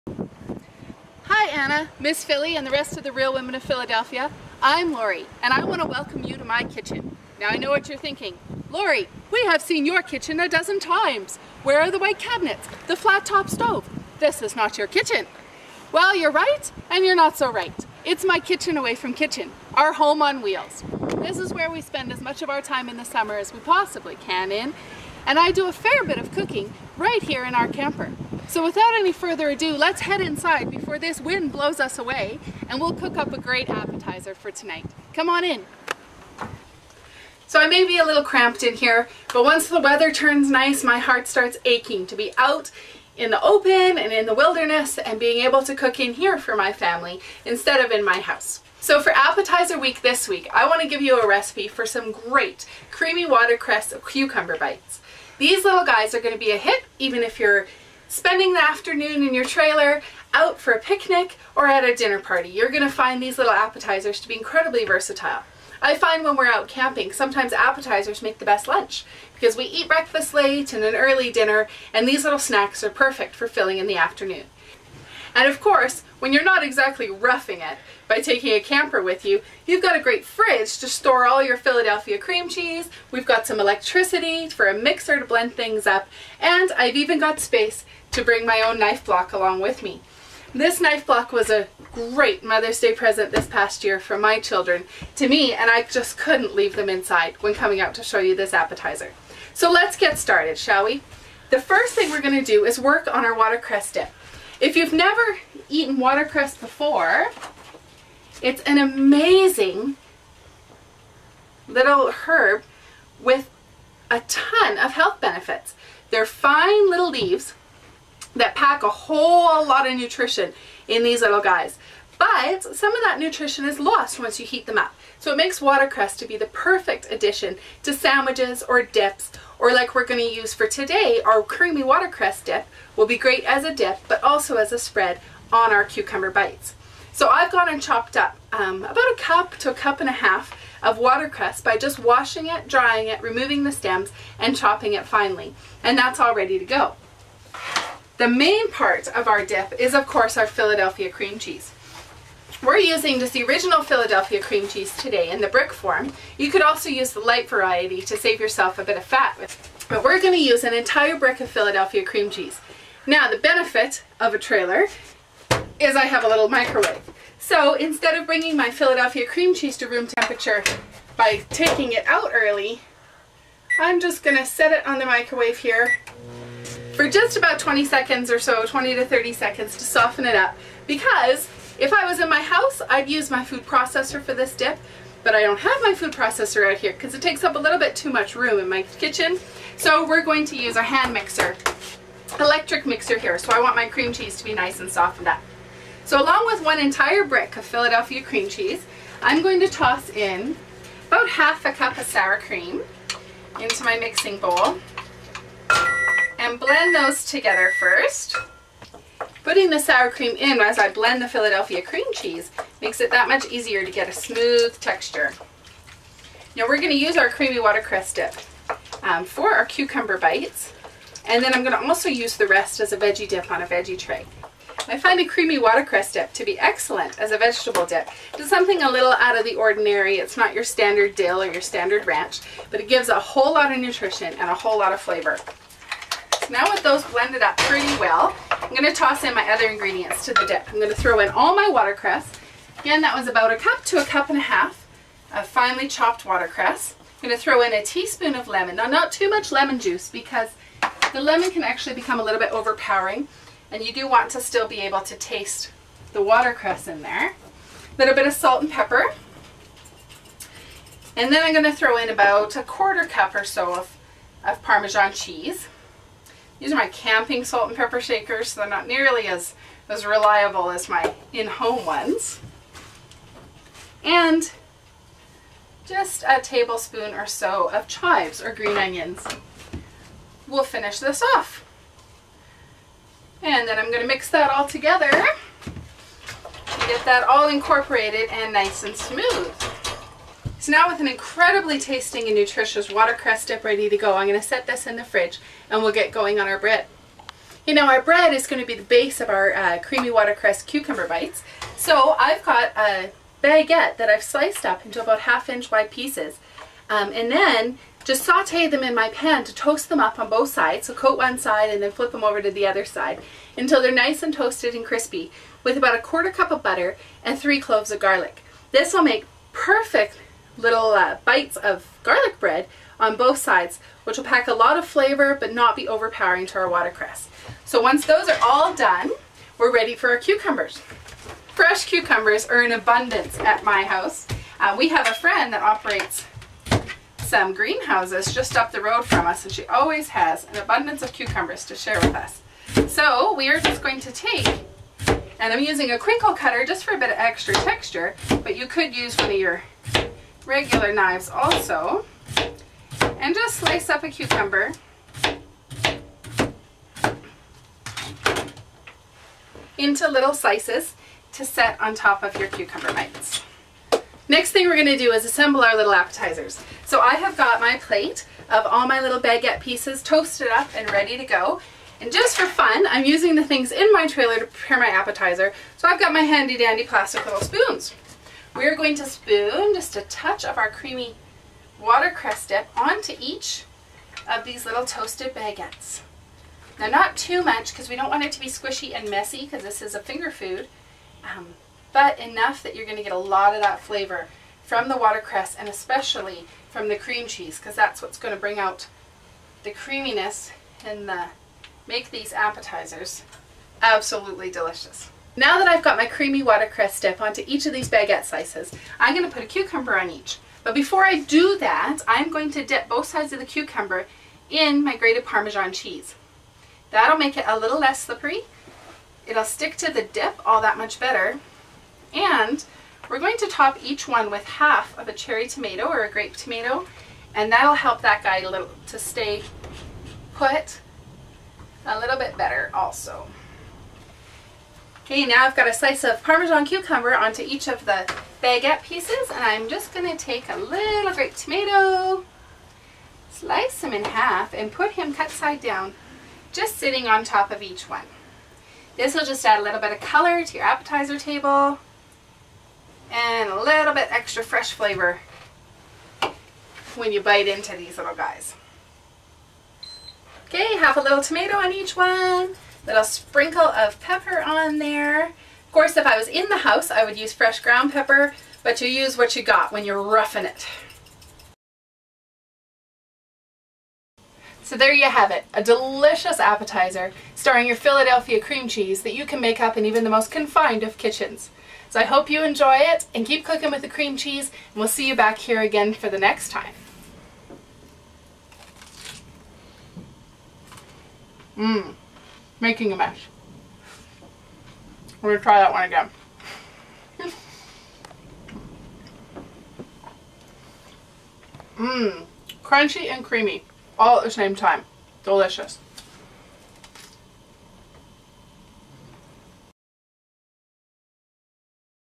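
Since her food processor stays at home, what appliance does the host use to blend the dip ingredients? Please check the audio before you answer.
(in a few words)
hand mixer.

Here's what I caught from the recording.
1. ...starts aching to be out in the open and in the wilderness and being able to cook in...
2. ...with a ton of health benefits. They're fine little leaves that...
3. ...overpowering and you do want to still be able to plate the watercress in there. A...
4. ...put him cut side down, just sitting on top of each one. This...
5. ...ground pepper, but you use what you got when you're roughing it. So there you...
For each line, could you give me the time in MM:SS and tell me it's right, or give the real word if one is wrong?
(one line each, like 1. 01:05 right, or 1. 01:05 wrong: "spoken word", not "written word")
1. 00:41 right
2. 01:53 right
3. 04:12 wrong: "taste", not "plate"
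4. 07:24 right
5. 07:47 right.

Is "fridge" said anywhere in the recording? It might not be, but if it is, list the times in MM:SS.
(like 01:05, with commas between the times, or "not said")
01:20, 04:55.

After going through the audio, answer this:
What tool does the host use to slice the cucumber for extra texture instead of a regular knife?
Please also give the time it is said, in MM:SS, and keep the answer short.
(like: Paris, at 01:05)
crinkle cutter, at 05:45.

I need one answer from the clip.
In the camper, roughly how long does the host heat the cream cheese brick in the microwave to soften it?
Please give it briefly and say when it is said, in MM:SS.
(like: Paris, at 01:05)
20 to 30 seconds, at 02:58.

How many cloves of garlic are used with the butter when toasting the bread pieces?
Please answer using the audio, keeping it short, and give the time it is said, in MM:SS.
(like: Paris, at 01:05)
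3, at 05:17.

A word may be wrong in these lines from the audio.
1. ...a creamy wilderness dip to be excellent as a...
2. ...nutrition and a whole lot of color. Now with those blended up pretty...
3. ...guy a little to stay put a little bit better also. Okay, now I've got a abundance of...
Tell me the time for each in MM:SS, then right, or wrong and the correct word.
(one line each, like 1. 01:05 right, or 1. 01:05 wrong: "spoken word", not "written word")
1. 03:45 wrong: "watercress", not "wilderness"
2. 03:53 wrong: "flavor", not "color"
3. 07:08 wrong: "slice", not "abundance".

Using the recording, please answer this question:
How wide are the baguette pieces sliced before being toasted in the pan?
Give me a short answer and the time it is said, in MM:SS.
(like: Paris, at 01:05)
half inch, at 05:05.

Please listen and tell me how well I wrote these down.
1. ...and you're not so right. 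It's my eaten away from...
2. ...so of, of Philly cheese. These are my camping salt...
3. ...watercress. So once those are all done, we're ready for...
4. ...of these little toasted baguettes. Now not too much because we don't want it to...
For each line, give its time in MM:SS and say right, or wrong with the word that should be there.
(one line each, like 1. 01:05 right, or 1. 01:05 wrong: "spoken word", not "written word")
1. 00:16 wrong: "kitchen", not "eaten"
2. 04:23 wrong: "Parmesan", not "Philly"
3. 05:26 right
4. 06:24 right.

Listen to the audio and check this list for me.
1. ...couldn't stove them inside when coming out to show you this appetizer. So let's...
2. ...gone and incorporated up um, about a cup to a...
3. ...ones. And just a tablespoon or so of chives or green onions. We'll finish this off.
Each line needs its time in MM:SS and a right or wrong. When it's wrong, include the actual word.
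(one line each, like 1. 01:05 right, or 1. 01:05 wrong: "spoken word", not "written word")
1. 01:36 wrong: "leave", not "stove"
2. 02:17 wrong: "chopped", not "incorporated"
3. 04:31 right.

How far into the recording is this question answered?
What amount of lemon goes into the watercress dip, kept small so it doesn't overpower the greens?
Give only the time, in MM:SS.
04:07.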